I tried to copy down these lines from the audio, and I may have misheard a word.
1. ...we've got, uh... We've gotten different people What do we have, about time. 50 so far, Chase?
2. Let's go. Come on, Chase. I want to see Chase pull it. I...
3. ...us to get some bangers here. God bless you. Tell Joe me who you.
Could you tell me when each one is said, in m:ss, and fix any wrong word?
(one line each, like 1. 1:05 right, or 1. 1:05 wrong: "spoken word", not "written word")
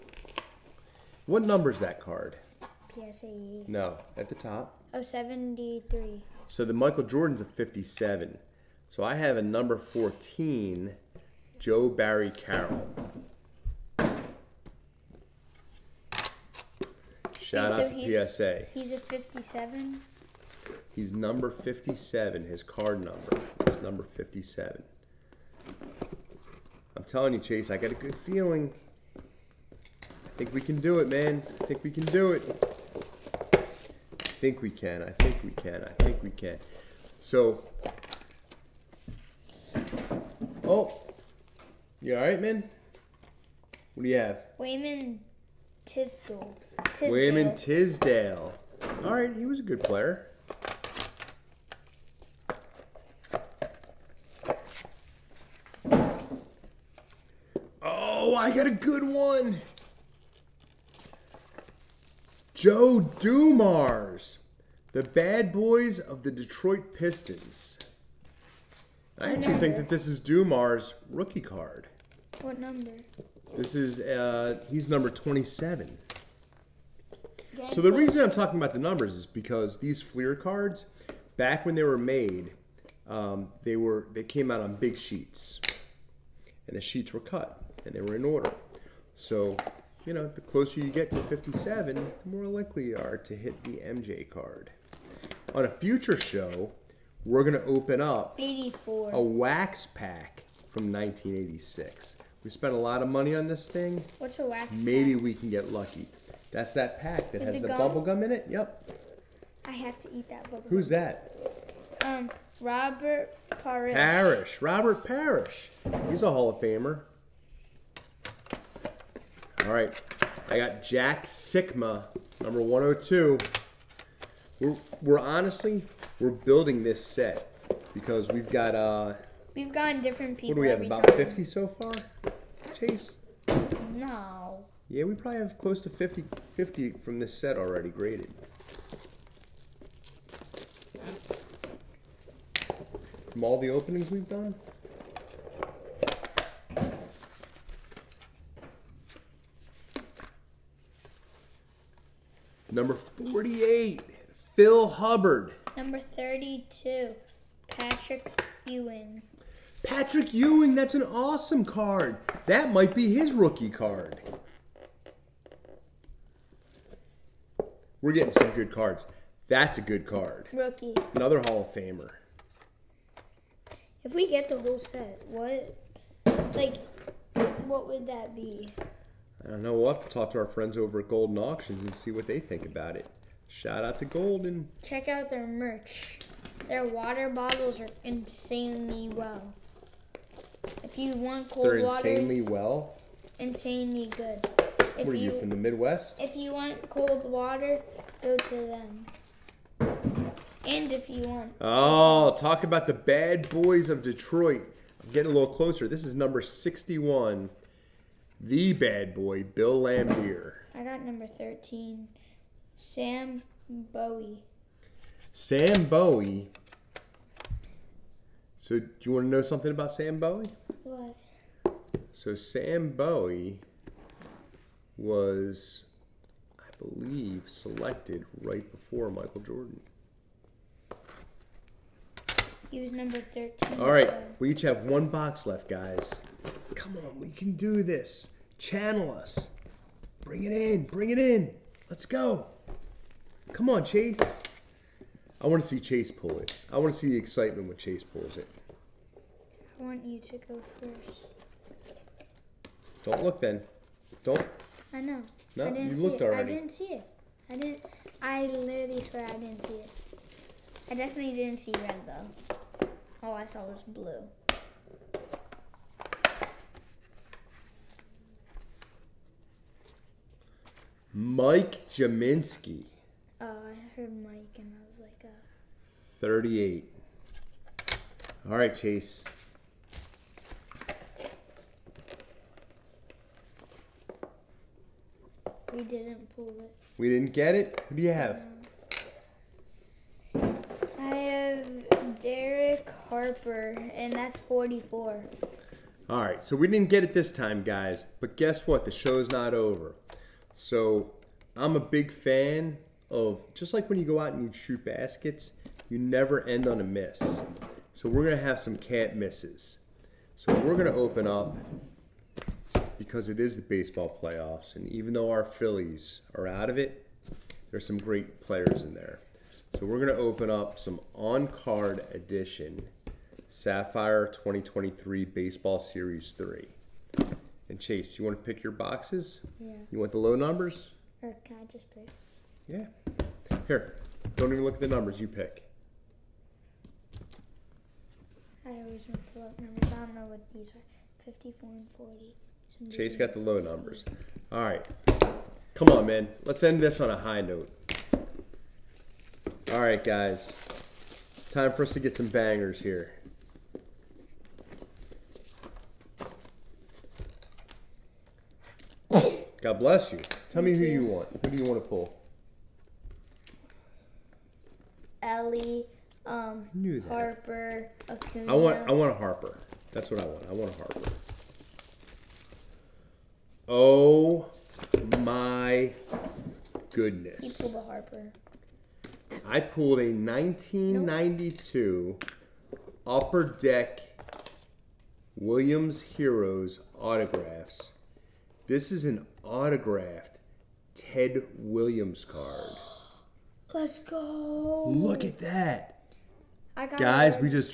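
1. 2:08 right
2. 4:01 right
3. 5:51 wrong: "Thank", not "Joe".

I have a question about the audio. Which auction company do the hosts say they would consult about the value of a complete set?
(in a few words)
Goldin Auctions.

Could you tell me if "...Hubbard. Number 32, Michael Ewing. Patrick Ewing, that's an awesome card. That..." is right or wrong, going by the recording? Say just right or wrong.
wrong.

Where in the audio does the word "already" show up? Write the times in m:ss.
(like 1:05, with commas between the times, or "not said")
2:17, 4:16.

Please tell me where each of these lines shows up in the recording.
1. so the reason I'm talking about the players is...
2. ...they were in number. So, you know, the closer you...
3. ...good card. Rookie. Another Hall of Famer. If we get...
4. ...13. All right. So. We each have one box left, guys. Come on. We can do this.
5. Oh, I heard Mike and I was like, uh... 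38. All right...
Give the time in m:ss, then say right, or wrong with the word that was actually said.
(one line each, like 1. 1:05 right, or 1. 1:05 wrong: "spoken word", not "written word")
1. 1:17 wrong: "numbers", not "players"
2. 1:27 wrong: "order", not "number"
3. 2:49 right
4. 3:53 right
5. 4:33 right.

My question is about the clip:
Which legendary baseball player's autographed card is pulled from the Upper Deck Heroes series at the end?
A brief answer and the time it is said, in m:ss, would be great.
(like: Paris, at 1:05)
Ted Williams, at 6:30.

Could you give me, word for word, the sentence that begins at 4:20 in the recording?
I definitely didn't see red though.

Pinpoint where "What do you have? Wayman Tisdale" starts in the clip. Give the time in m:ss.
0:43.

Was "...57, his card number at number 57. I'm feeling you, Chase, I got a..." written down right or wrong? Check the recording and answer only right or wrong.
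wrong.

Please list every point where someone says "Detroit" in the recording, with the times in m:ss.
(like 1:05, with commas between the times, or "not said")
1:06, 3:24.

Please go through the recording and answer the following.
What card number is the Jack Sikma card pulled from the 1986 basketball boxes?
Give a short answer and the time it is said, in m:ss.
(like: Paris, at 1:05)
102, at 2:02.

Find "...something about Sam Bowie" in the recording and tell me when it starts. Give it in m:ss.
3:39.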